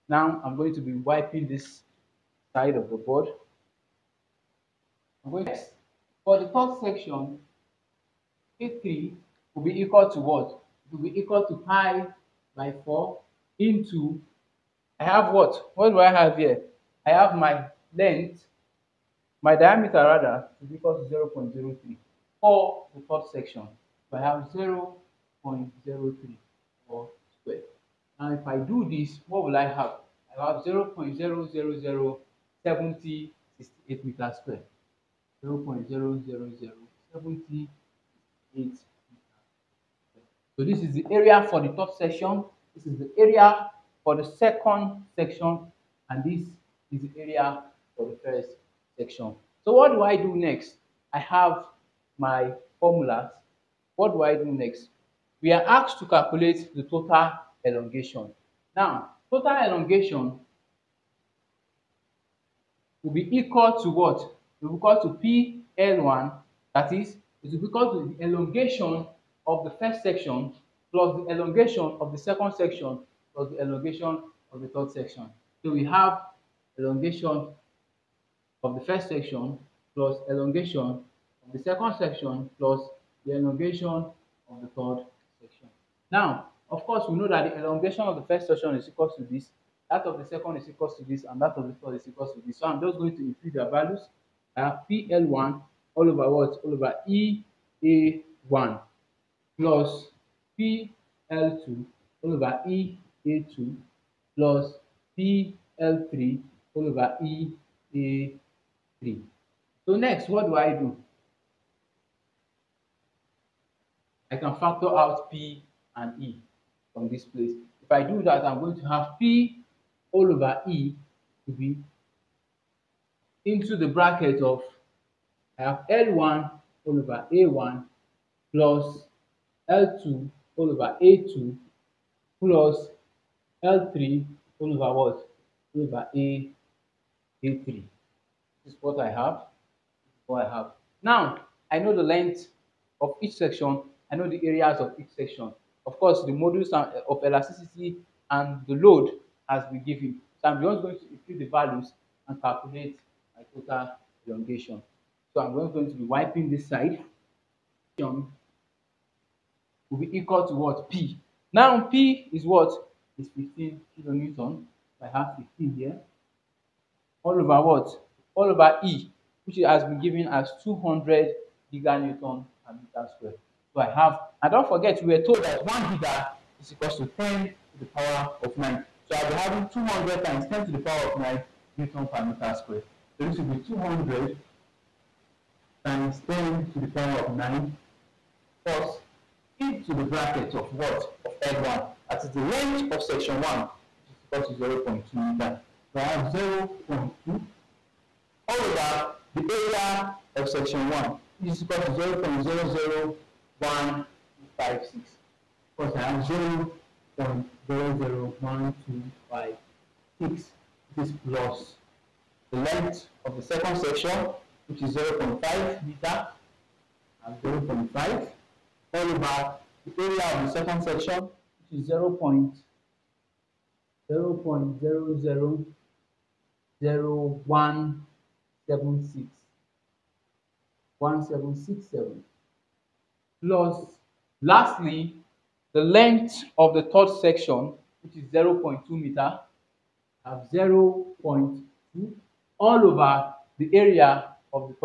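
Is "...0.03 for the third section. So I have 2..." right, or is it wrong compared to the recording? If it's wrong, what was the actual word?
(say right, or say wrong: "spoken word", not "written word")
wrong: "0", not "2".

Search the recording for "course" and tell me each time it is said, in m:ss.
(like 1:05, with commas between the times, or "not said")
1:26, 2:25.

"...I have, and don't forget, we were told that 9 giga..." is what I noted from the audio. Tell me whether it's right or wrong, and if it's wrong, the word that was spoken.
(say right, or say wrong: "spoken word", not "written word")
wrong: "1", not "9".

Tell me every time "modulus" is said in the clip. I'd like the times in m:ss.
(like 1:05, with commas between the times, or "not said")
2:26.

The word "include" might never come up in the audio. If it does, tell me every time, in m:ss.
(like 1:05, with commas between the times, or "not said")
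1:33, 2:31.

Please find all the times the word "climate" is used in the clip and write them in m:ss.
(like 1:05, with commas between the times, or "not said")
not said.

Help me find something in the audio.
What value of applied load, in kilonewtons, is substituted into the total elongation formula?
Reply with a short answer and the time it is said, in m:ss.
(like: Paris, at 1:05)
15, at 2:43.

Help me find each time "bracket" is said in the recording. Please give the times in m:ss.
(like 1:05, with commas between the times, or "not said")
2:03, 3:10.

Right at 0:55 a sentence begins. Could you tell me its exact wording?
We are asked to calculate the total elongation.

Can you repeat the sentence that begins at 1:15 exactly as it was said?
So we have elongation of the first section plus elongation of the second section plus the elongation of the third section.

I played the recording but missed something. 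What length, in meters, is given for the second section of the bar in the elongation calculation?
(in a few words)
0.5 meter.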